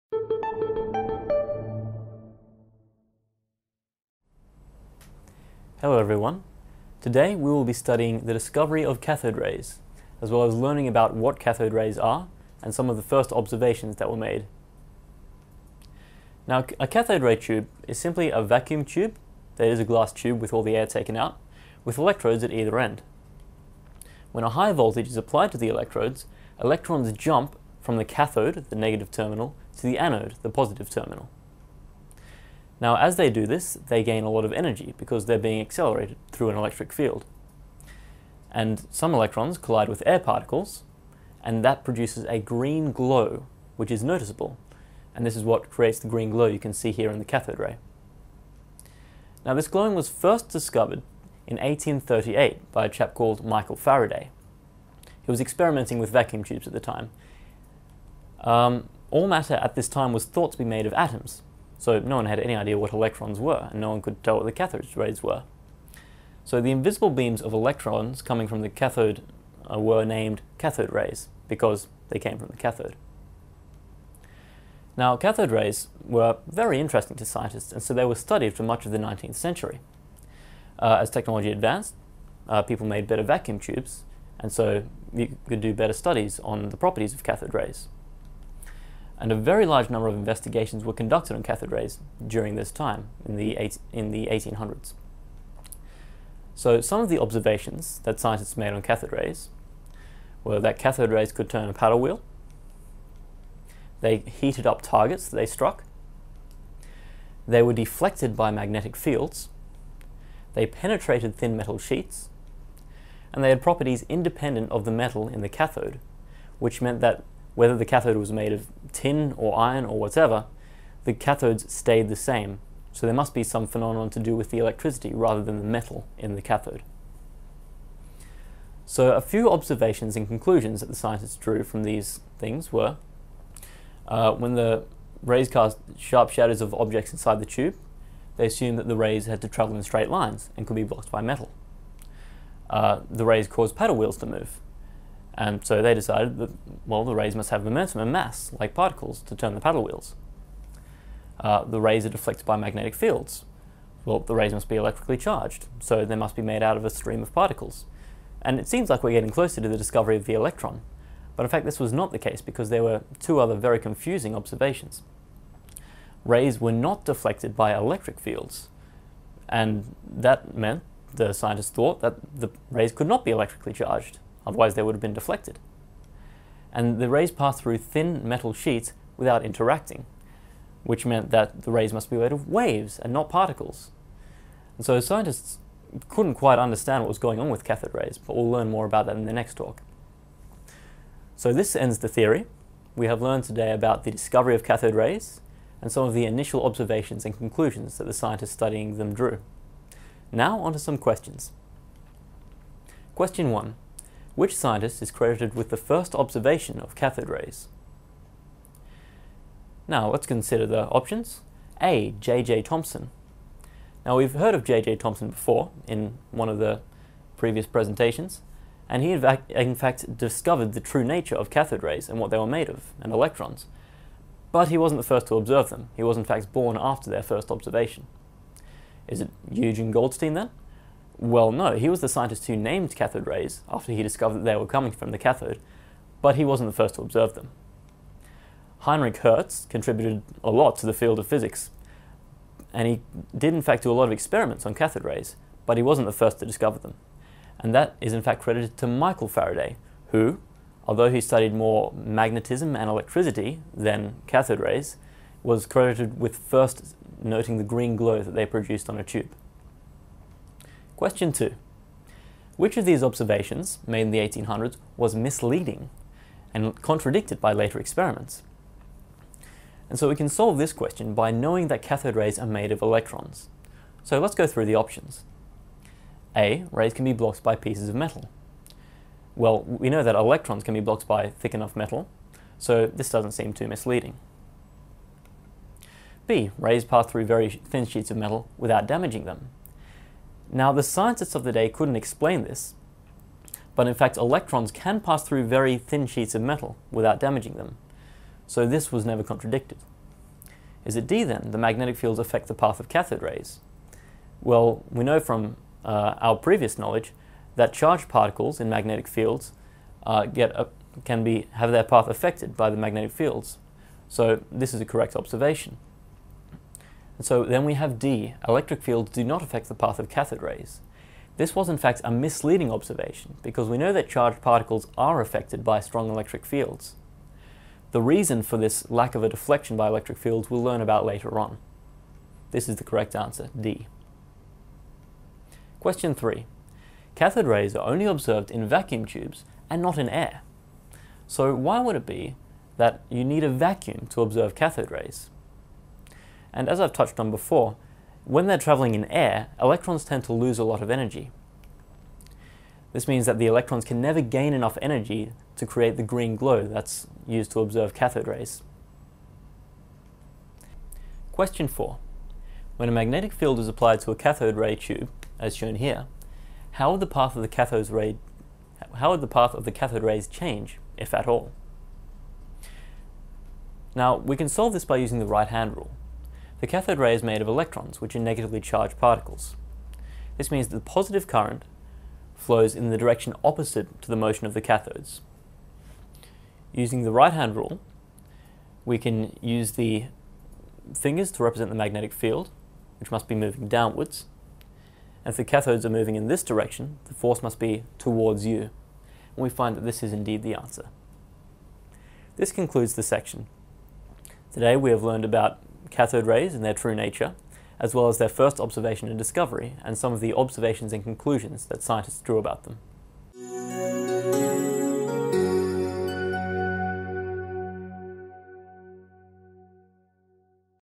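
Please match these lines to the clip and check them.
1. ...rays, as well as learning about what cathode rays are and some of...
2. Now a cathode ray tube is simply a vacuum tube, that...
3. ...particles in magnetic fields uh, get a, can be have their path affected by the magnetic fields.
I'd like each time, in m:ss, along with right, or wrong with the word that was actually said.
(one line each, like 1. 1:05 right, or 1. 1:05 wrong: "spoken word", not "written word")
1. 0:09 right
2. 0:16 right
3. 5:08 right.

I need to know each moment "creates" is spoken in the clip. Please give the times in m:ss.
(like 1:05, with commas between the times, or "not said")
0:45, 5:55.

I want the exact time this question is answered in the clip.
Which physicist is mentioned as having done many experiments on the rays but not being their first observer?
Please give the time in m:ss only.
3:58.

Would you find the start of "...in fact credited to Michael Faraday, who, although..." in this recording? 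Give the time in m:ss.
4:08.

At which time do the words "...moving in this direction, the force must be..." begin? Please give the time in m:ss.
6:35.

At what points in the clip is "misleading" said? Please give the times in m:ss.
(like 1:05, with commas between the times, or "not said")
4:25, 4:43, 5:22.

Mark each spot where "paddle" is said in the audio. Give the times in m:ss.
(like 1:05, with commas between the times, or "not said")
1:41, 2:23, 2:29.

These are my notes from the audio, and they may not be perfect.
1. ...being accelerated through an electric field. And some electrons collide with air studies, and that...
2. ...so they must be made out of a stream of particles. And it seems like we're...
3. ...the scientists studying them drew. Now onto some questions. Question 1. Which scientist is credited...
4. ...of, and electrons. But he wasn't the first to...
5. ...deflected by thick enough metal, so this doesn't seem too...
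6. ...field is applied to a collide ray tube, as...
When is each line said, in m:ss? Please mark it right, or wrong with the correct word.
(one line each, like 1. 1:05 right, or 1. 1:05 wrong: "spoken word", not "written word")
1. 0:35 wrong: "particles", not "studies"
2. 2:35 right
3. 3:18 right
4. 3:42 right
5. 4:40 wrong: "blocked", not "deflected"
6. 6:03 wrong: "cathode", not "collide".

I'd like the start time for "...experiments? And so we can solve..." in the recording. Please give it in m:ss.
4:27.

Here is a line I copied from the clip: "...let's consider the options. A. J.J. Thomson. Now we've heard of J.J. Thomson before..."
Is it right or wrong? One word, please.
right.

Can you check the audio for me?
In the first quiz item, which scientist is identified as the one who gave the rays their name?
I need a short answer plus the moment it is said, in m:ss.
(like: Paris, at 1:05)
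Eugene Goldstein, at 3:49.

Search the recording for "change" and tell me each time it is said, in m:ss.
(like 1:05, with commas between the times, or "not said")
6:10.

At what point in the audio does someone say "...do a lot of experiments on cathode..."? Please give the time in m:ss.
4:03.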